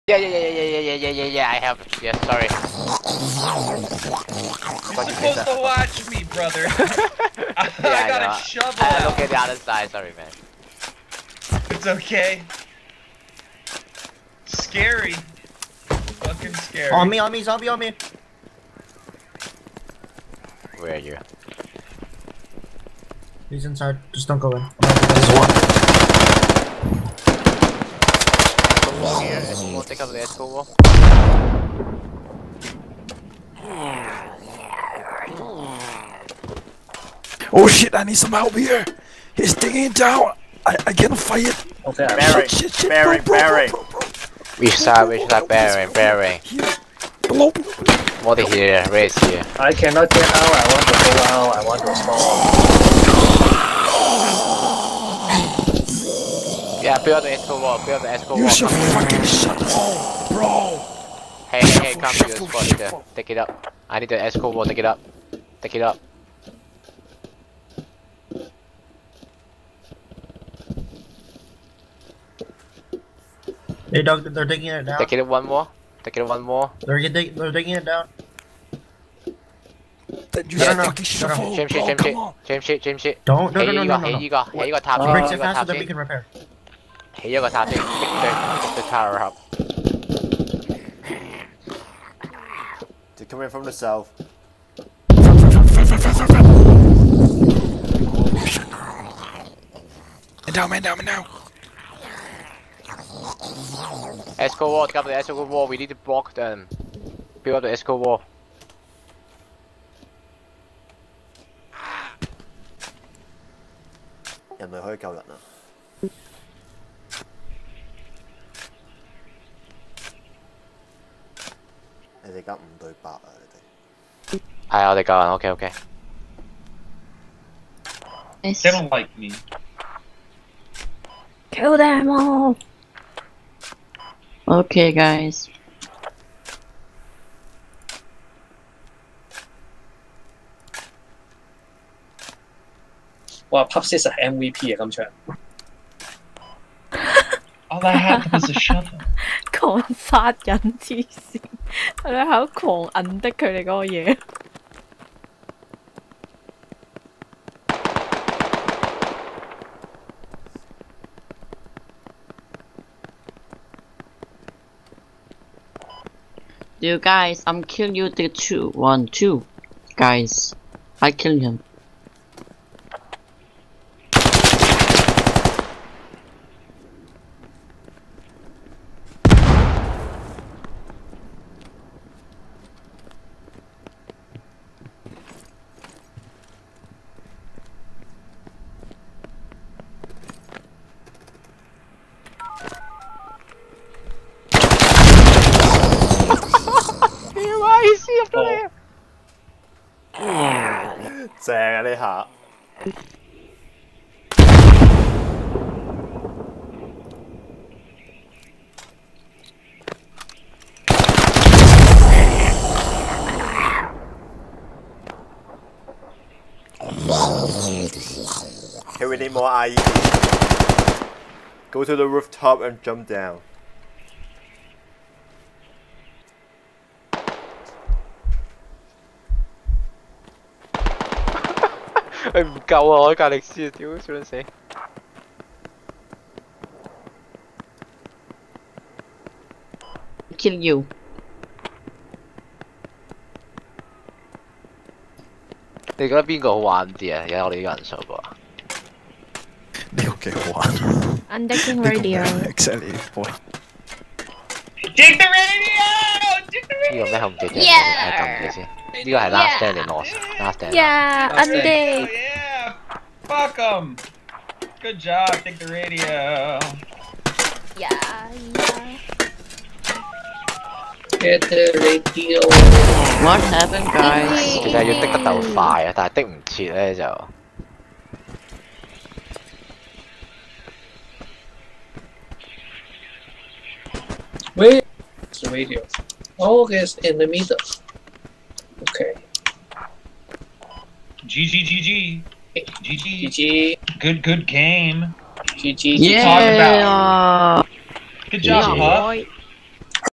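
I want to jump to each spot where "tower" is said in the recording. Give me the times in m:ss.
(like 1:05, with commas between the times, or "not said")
1:28.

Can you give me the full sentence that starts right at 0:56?
Yeah, build the expo wall, build the expo wall.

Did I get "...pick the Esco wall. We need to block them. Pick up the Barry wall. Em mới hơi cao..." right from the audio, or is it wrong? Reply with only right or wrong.
wrong.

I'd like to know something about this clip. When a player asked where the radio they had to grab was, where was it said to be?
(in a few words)
In the middle.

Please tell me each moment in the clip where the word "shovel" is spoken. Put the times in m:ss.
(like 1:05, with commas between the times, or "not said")
0:08, 2:28.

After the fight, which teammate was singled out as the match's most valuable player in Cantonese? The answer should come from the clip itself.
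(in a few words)
Pops.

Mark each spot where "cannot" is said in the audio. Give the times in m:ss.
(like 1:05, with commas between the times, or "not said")
0:40, 0:49.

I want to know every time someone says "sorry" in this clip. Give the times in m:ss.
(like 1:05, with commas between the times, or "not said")
0:02, 0:09.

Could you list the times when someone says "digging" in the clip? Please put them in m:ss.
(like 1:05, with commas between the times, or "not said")
0:39, 1:17.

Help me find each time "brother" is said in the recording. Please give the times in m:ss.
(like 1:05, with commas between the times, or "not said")
0:06.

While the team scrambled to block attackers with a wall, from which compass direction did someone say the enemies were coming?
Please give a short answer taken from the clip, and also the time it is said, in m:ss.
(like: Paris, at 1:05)
South, at 1:33.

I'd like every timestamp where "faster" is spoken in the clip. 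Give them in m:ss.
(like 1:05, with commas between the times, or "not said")
1:25.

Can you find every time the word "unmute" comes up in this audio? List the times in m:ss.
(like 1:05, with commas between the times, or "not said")
not said.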